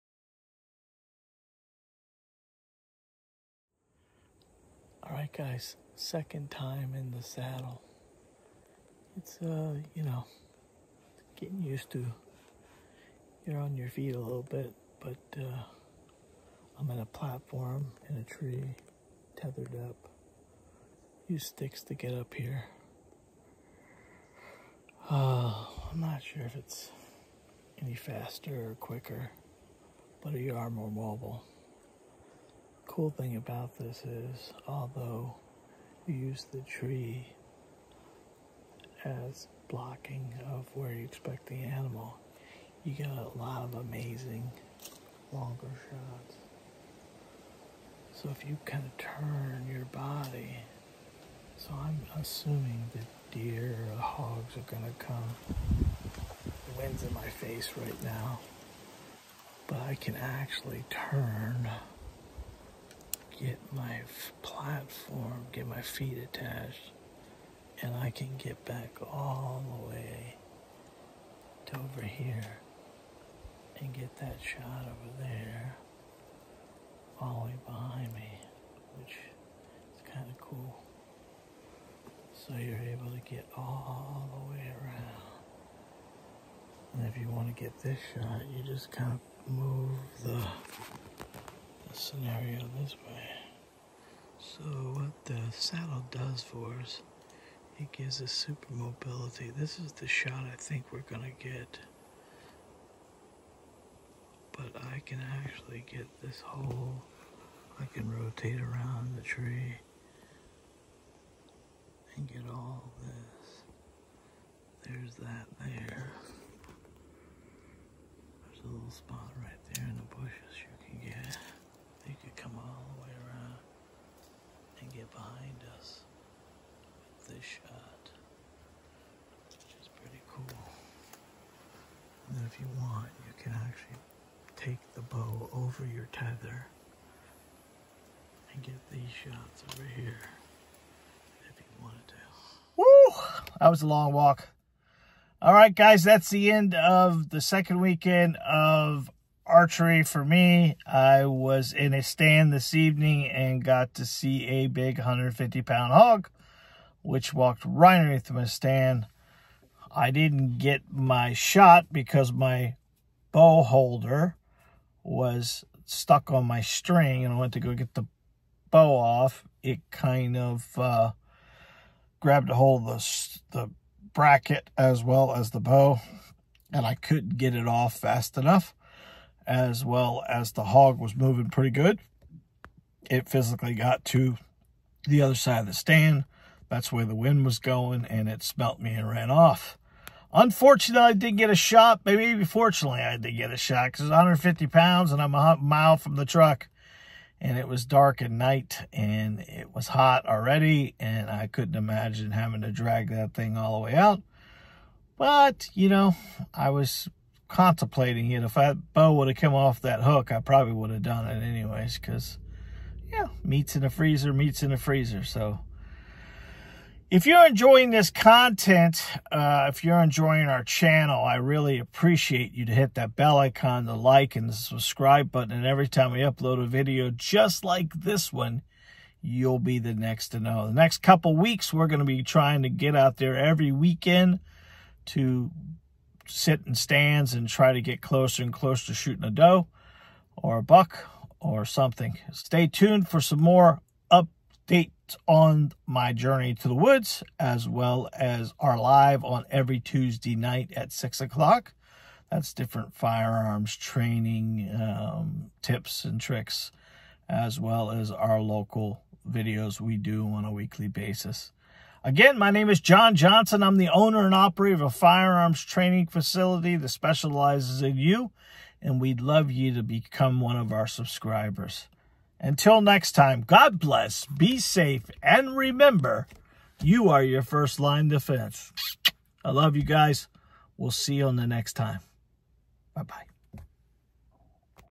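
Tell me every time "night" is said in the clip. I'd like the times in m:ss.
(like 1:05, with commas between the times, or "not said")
3:18, 4:10.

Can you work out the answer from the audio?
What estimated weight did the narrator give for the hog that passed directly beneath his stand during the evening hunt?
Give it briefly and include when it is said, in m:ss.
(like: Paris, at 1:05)
150 pounds, at 2:34.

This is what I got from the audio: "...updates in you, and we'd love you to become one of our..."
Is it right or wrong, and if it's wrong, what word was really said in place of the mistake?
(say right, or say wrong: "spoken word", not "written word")
wrong: "specializes", not "updates".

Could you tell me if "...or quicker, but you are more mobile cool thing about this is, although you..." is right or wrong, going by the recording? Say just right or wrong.
right.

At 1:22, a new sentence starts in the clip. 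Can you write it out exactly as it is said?
So you're able to get all the way around.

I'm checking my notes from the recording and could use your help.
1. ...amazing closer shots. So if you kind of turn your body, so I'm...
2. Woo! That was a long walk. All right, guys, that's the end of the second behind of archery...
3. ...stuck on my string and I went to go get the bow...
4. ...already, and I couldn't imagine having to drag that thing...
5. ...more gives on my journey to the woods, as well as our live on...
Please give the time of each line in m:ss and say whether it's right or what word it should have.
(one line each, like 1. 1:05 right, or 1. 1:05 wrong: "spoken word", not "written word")
1. 0:43 wrong: "longer", not "closer"
2. 2:22 wrong: "weekend", not "behind"
3. 2:45 right
4. 3:20 right
5. 4:03 wrong: "updates", not "gives".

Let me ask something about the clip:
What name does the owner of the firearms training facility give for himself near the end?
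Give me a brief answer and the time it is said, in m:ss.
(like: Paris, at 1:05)
John Johnson, at 4:22.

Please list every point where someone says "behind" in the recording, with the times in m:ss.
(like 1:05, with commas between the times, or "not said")
1:17, 2:05.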